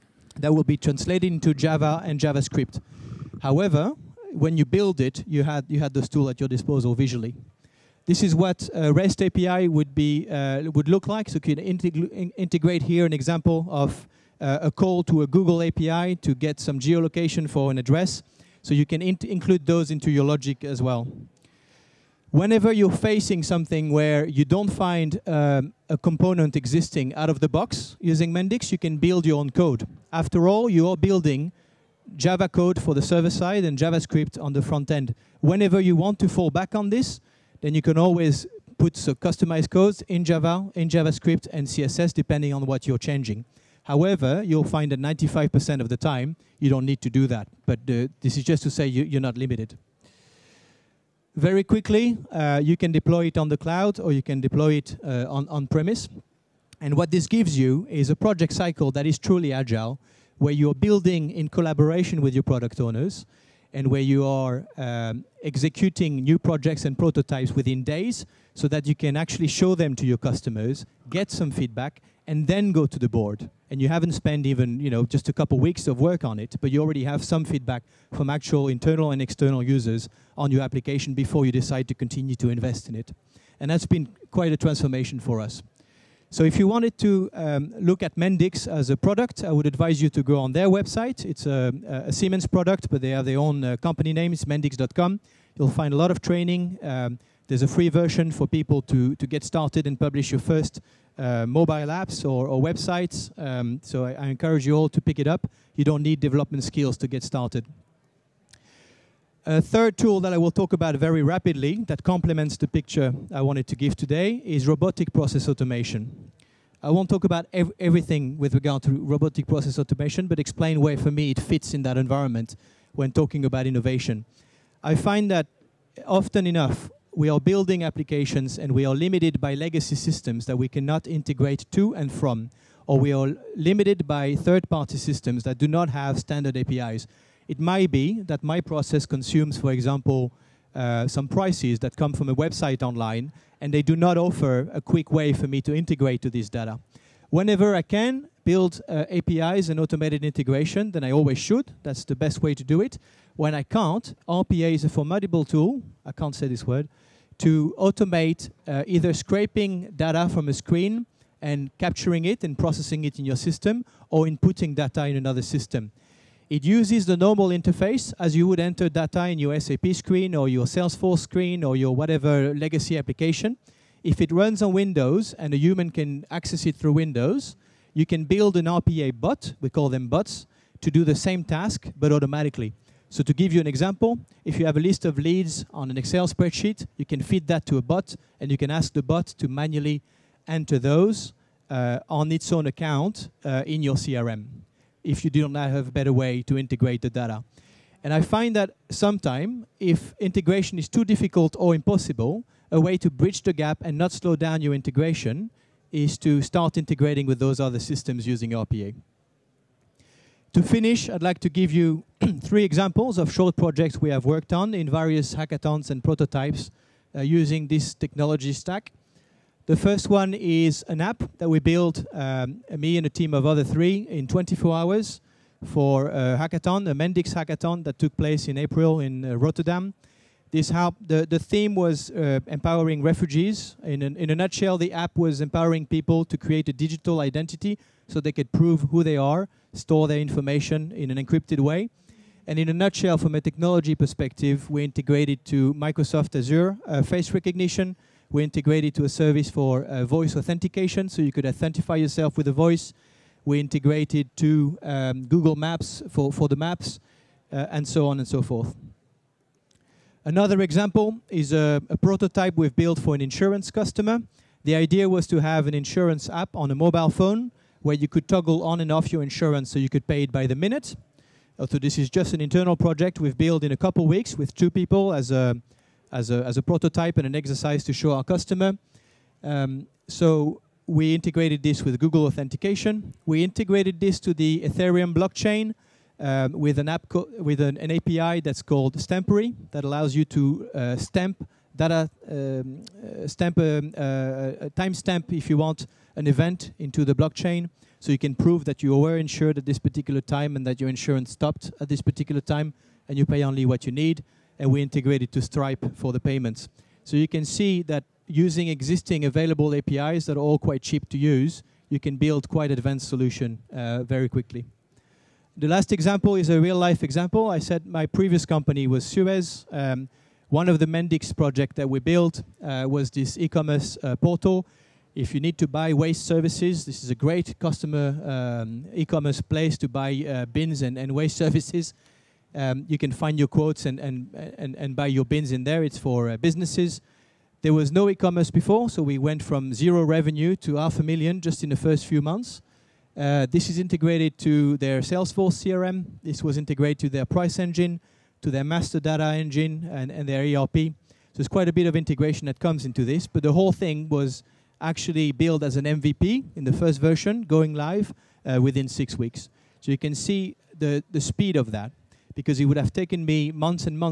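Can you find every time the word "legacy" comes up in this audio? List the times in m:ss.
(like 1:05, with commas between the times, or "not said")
2:09, 2:52.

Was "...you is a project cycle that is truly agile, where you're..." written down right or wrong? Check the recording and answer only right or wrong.
right.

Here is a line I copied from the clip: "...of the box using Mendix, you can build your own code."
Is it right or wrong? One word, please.
right.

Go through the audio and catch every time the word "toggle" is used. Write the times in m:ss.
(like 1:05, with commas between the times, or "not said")
4:28.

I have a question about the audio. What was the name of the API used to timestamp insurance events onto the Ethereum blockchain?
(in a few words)
Stampery.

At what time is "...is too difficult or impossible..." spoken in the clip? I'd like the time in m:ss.
3:20.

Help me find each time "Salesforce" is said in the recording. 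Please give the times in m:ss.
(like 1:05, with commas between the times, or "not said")
2:50, 5:45.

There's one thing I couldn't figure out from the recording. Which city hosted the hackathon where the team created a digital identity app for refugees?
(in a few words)
Rotterdam.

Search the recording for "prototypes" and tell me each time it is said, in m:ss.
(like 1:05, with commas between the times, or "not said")
1:06, 3:36, 4:21, 4:36.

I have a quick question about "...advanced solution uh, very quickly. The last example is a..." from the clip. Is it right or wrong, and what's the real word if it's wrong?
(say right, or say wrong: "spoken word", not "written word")
right.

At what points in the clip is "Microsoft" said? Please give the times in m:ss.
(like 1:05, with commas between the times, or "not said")
4:05.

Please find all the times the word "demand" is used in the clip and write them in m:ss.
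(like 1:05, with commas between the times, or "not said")
not said.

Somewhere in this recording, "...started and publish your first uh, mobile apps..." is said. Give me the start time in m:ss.
1:39.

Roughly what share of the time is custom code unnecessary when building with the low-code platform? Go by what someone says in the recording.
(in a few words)
95%.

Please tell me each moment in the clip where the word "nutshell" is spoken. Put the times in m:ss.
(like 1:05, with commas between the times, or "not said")
3:54, 4:02.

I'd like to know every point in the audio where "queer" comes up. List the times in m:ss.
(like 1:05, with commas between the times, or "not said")
not said.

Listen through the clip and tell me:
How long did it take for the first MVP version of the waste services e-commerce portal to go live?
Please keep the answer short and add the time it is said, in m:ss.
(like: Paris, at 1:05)
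6 weeks, at 5:58.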